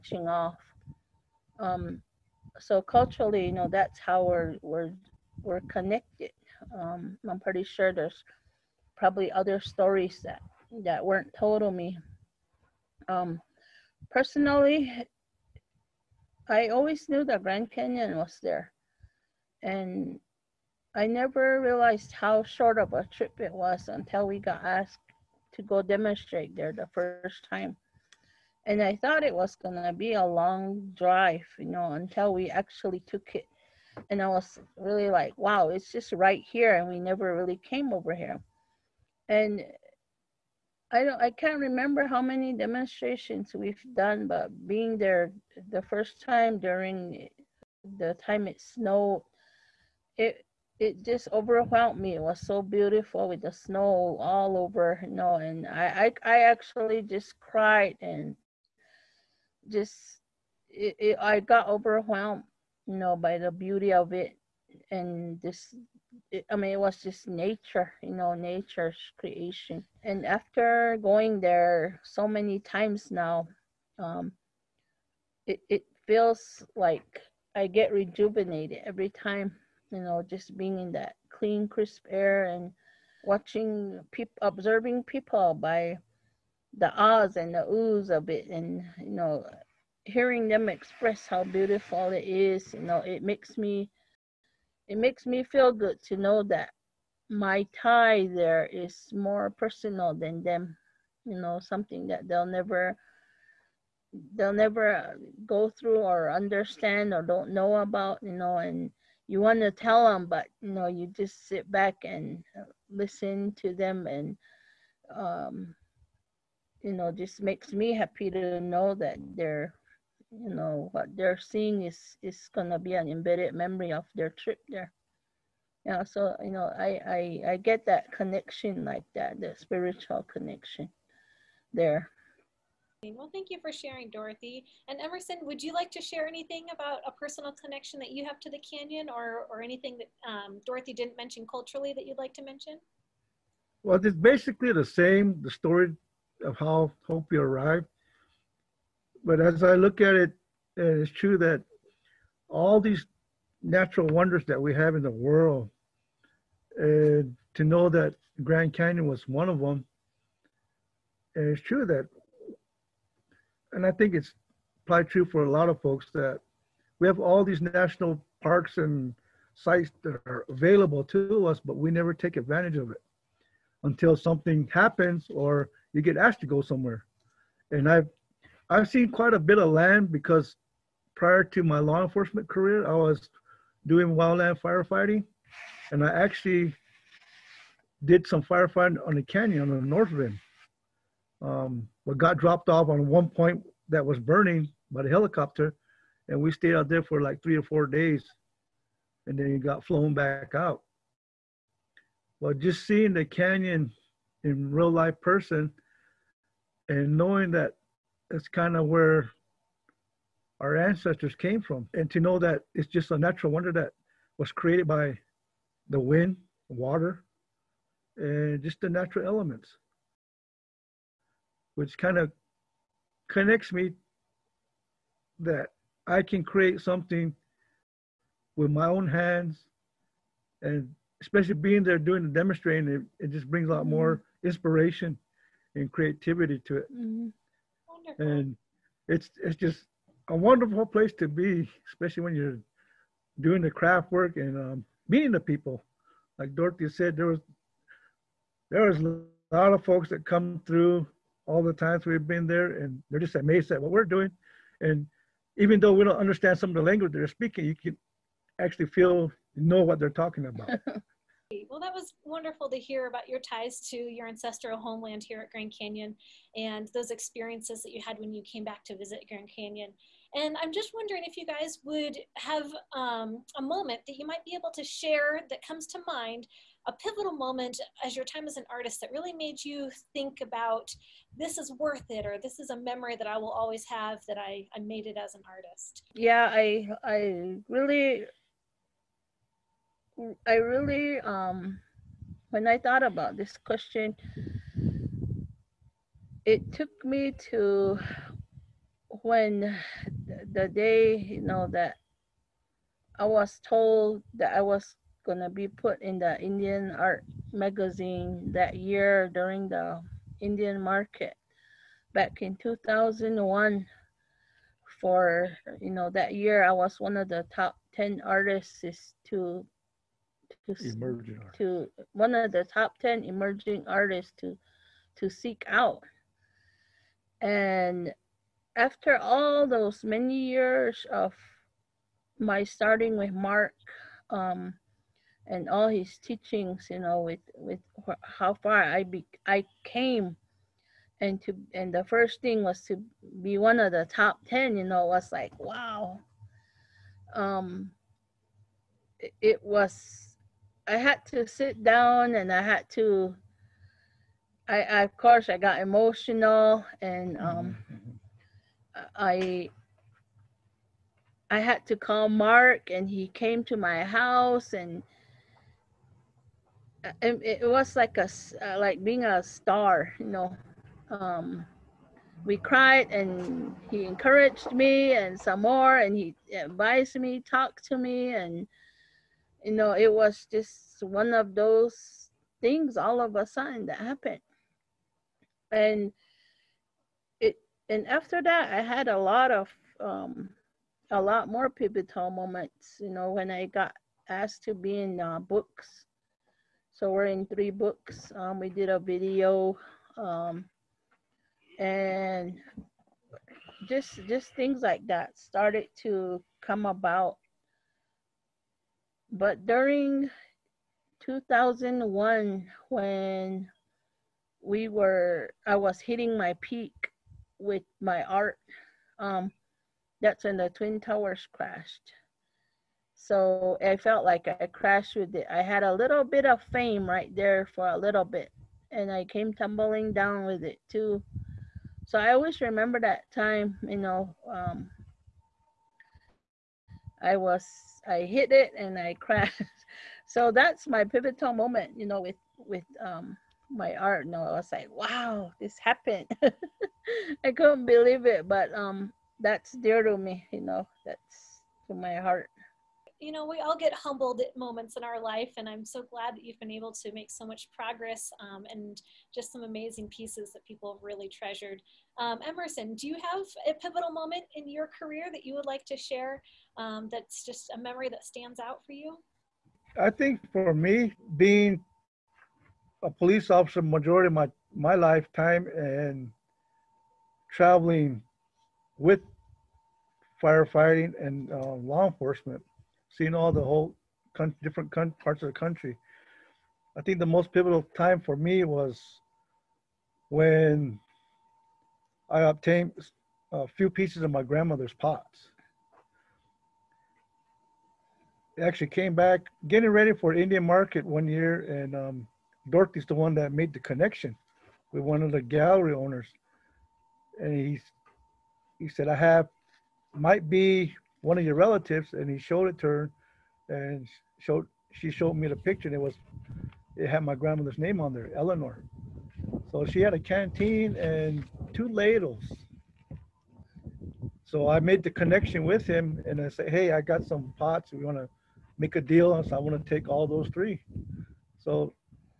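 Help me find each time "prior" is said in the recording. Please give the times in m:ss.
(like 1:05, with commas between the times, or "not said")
3:01.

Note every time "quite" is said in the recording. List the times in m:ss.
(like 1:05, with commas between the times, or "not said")
2:59.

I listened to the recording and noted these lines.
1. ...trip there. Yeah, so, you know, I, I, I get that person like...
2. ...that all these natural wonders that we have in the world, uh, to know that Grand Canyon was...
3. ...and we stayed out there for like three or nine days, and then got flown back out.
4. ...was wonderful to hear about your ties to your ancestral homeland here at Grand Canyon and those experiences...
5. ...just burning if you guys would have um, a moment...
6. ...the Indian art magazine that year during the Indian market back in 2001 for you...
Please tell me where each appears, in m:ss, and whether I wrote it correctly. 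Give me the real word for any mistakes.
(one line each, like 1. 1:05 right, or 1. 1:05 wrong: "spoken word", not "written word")
1. 2:04 wrong: "connection", not "person"
2. 2:31 right
3. 3:16 wrong: "four", not "nine"
4. 4:21 right
5. 4:30 wrong: "wondering", not "burning"
6. 5:06 right.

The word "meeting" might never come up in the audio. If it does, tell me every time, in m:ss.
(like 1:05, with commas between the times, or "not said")
4:05.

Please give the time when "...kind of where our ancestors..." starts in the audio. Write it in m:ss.
3:28.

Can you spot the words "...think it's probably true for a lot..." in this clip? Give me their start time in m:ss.
2:43.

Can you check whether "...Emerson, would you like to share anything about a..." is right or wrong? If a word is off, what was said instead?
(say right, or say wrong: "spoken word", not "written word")
right.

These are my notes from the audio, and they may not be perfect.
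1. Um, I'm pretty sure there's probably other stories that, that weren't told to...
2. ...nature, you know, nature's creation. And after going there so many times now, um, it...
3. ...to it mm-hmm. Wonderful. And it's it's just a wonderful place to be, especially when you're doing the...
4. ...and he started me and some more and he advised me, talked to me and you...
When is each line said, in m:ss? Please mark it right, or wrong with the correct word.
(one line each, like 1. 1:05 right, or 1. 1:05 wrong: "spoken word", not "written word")
1. 0:06 right
2. 1:07 right
3. 3:56 right
4. 6:13 wrong: "encouraged", not "started".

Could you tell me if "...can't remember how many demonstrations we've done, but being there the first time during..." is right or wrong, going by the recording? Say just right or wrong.
right.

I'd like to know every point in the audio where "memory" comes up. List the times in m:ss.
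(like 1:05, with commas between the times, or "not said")
2:03, 4:42, 7:47.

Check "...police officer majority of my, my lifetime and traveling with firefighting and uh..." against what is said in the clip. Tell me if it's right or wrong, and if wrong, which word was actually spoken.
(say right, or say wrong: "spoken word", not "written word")
right.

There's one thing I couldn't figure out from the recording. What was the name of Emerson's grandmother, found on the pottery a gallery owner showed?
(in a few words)
Eleanor.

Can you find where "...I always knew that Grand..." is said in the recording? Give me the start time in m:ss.
0:16.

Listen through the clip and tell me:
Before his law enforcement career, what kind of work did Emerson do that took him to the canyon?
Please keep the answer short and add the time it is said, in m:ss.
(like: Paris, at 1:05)
Wildland firefighting, at 3:04.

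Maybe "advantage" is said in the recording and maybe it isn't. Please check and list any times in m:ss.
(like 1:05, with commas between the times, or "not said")
2:52.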